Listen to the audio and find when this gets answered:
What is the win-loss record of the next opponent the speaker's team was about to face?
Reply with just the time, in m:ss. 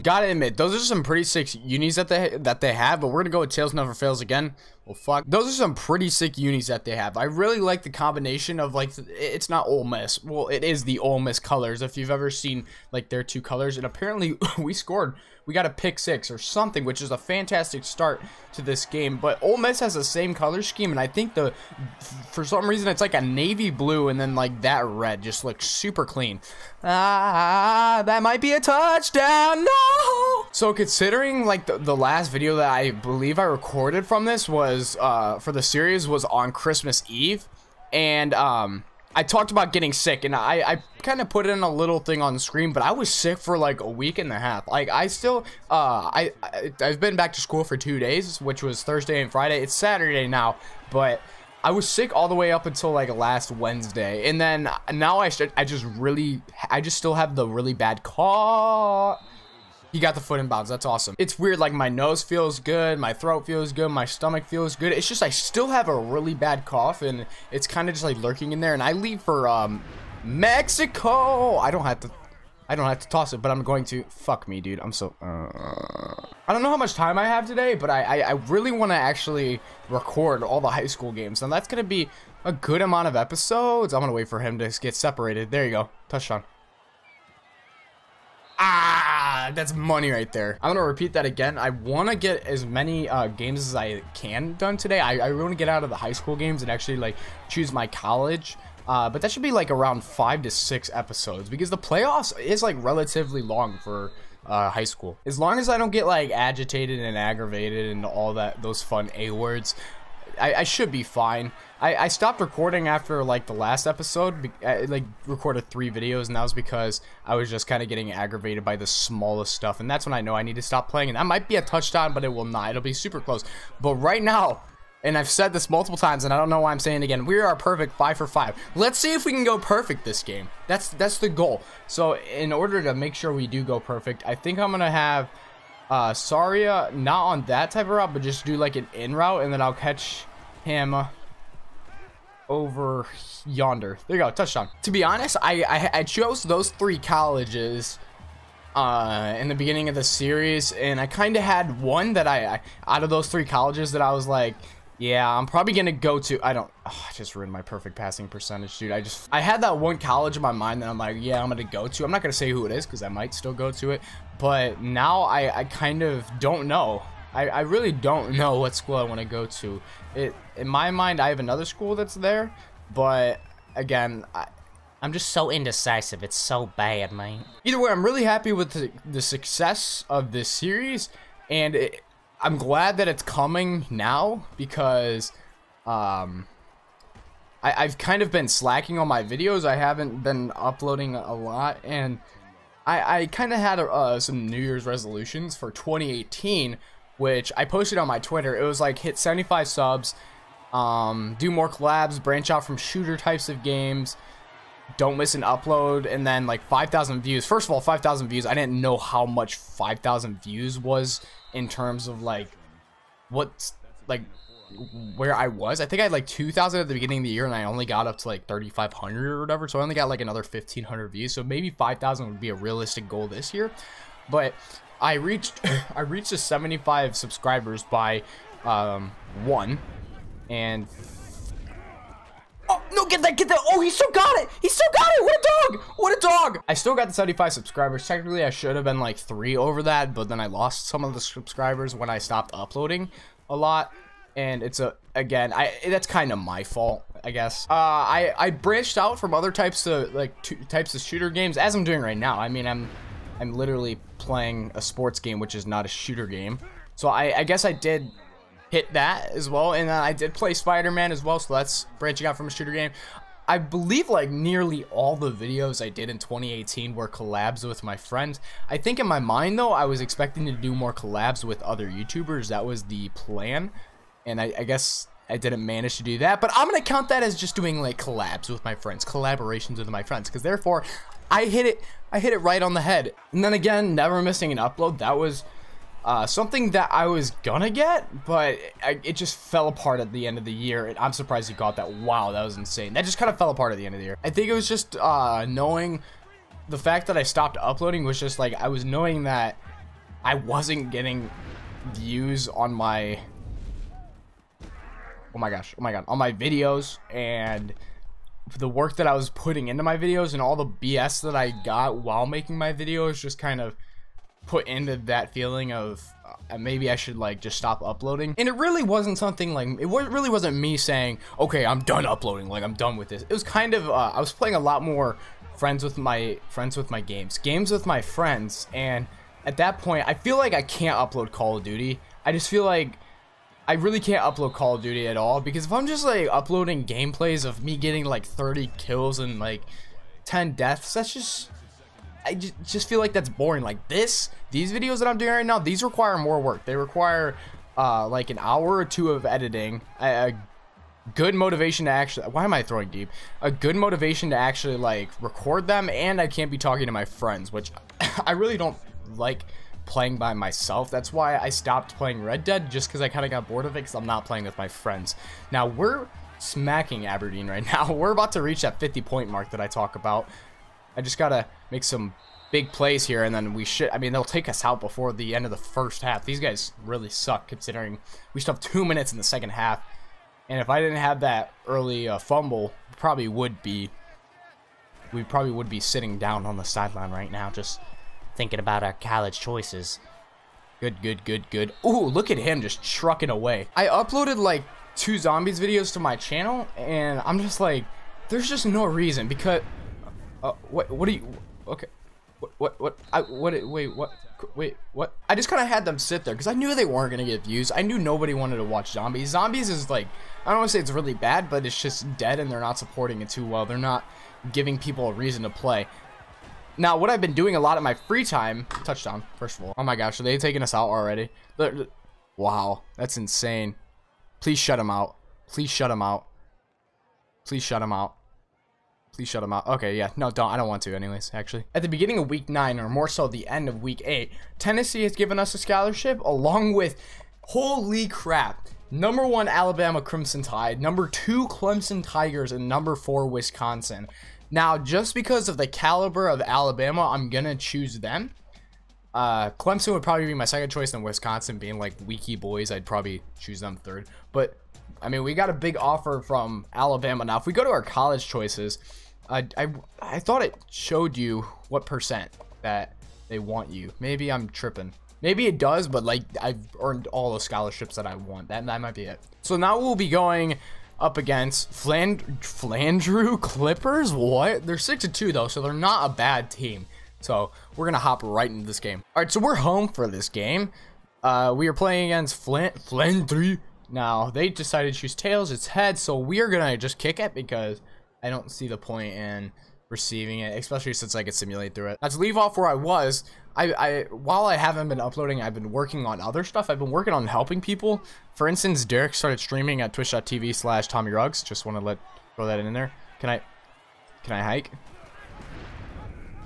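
7:54.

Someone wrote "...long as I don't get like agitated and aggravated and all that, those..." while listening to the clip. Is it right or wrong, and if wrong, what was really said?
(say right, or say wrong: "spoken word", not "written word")
right.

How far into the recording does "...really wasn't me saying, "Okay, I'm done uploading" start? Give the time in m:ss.
5:19.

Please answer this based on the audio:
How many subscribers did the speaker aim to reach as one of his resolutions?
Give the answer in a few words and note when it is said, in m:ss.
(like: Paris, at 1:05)
75, at 3:18.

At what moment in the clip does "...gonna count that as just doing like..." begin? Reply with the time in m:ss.
4:36.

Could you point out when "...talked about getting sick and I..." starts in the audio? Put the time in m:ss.
0:39.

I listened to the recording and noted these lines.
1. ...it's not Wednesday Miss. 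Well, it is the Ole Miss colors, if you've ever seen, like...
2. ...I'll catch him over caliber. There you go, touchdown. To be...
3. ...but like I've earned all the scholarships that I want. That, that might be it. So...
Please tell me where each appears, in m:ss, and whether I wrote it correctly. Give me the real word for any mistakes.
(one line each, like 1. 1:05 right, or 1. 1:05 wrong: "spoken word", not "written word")
1. 0:09 wrong: "Ole", not "Wednesday"
2. 2:19 wrong: "yonder", not "caliber"
3. 7:45 right.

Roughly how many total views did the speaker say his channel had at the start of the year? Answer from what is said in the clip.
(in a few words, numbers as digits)
2,000.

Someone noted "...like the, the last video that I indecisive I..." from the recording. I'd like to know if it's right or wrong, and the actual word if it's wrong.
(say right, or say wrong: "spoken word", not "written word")
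wrong: "believe", not "indecisive".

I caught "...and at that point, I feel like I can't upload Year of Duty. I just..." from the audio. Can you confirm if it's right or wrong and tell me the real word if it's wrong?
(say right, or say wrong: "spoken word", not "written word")
wrong: "Call", not "Year".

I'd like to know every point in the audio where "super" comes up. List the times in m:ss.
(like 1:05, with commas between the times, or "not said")
0:25, 2:02.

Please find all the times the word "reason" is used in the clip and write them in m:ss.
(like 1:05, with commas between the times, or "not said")
0:22, 6:38, 6:55.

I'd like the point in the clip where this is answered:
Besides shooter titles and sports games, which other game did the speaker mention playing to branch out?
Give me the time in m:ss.
4:20.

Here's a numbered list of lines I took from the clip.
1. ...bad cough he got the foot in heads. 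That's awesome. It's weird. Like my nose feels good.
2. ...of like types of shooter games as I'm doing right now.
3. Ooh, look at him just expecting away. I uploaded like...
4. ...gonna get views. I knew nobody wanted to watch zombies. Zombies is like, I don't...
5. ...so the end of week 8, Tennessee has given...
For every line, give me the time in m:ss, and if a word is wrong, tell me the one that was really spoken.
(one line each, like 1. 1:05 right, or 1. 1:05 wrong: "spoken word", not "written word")
1. 0:57 wrong: "bounds", not "heads"
2. 4:09 right
3. 6:31 wrong: "trucking", not "expecting"
4. 6:47 right
5. 7:13 right.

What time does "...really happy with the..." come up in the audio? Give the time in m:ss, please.
2:58.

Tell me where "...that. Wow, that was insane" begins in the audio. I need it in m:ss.
4:51.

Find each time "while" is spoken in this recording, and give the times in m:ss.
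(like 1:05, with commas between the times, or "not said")
5:11, 8:14.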